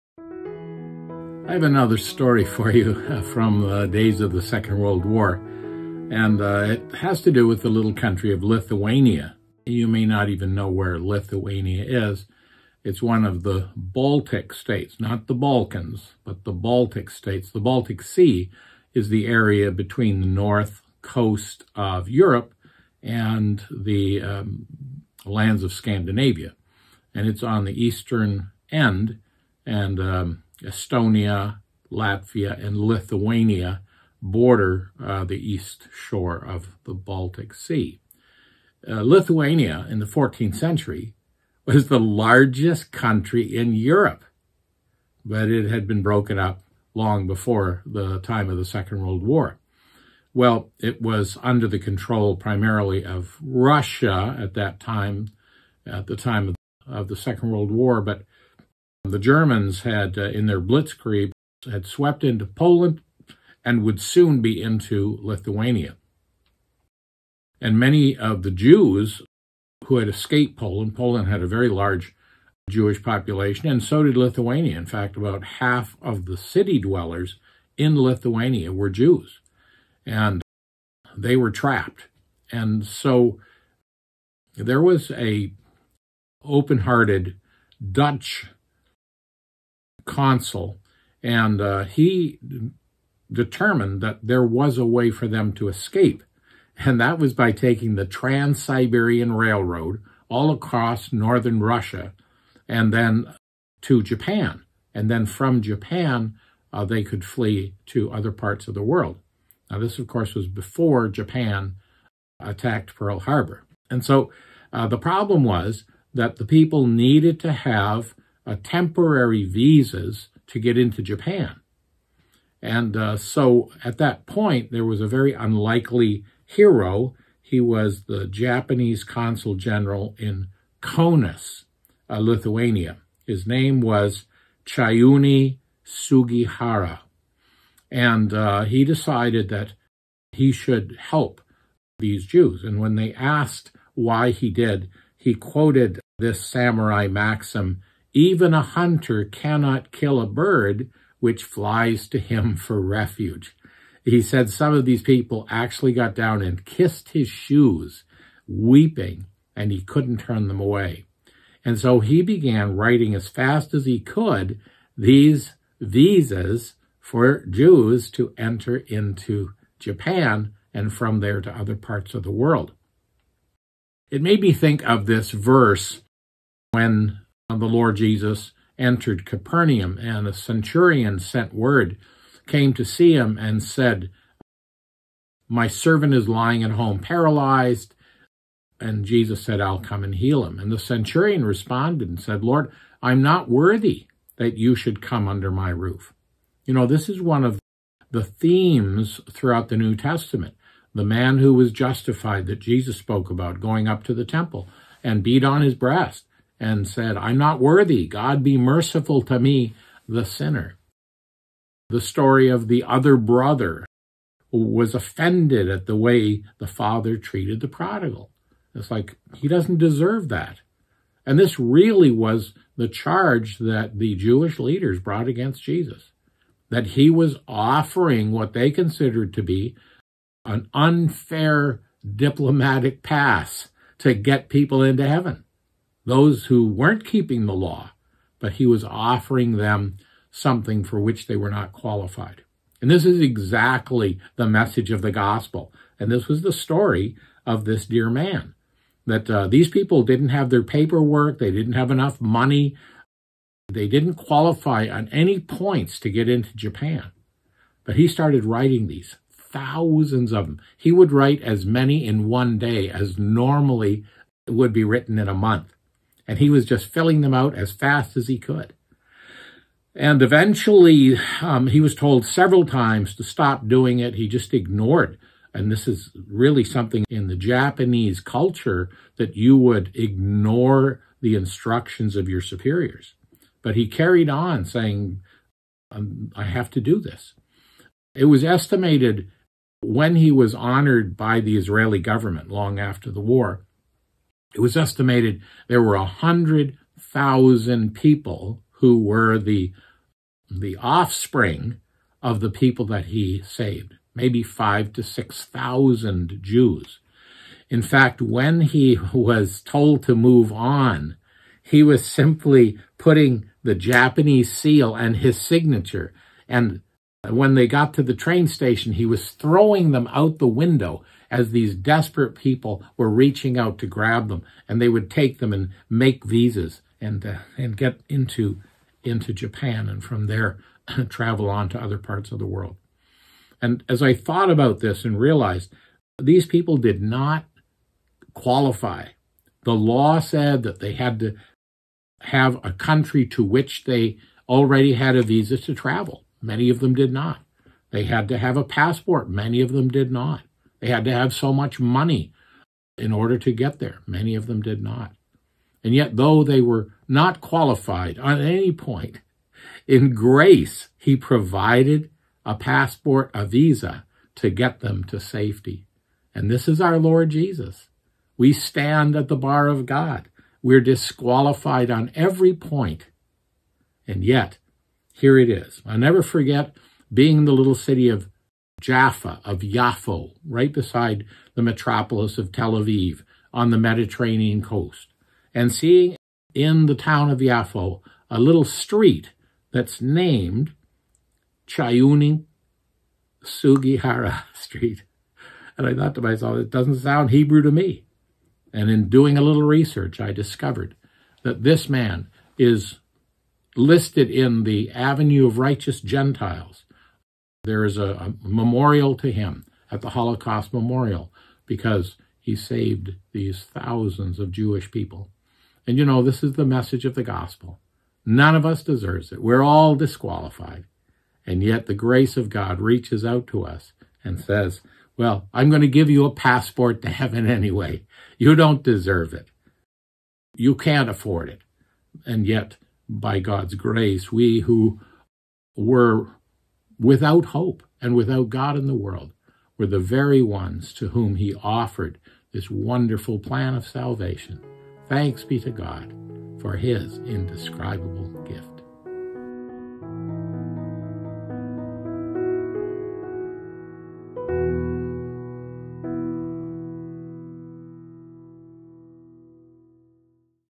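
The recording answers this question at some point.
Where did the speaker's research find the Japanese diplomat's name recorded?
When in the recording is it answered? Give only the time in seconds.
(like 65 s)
404 s.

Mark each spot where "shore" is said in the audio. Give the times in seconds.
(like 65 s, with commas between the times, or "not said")
35 s.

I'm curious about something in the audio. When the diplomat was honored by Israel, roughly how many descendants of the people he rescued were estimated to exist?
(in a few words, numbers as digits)
100,000.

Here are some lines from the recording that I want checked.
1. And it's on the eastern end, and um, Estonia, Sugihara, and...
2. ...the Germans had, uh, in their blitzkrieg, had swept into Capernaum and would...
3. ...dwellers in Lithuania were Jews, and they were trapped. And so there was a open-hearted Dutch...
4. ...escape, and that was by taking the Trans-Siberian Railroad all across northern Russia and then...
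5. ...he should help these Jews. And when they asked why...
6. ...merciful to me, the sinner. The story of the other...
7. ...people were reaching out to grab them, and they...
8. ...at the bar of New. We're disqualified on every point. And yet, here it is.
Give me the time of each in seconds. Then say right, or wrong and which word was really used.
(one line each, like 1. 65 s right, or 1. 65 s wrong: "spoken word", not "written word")
1. 27 s wrong: "Latvia", not "Sugihara"
2. 59 s wrong: "Poland", not "Capernaum"
3. 76 s right
4. 95 s right
5. 140 s right
6. 208 s right
7. 322 s right
8. 369 s wrong: "God", not "New".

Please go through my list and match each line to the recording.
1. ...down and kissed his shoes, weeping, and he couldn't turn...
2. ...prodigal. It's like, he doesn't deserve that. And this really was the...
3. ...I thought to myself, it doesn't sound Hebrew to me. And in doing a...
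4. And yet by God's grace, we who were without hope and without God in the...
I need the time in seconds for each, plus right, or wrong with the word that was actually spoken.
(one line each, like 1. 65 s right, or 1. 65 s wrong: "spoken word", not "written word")
1. 156 s right
2. 217 s right
3. 395 s right
4. 432 s right.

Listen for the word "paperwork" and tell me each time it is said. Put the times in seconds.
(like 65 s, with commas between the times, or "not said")
250 s.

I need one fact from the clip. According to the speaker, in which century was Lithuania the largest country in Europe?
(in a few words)
14th century.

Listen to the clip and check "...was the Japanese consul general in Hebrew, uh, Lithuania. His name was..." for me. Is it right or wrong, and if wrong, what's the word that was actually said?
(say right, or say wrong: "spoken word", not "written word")
wrong: "Kaunas", not "Hebrew".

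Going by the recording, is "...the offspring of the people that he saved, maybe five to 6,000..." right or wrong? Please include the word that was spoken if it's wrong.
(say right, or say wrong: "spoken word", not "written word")
right.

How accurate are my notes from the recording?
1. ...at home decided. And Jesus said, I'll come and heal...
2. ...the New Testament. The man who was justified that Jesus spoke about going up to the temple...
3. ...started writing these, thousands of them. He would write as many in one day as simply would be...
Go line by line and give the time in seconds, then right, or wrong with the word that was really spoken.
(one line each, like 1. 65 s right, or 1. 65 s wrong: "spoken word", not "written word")
1. 186 s wrong: "paralyzed", not "decided"
2. 199 s right
3. 258 s wrong: "normally", not "simply".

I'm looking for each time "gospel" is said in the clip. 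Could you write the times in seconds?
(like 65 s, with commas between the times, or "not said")
245 s, 417 s.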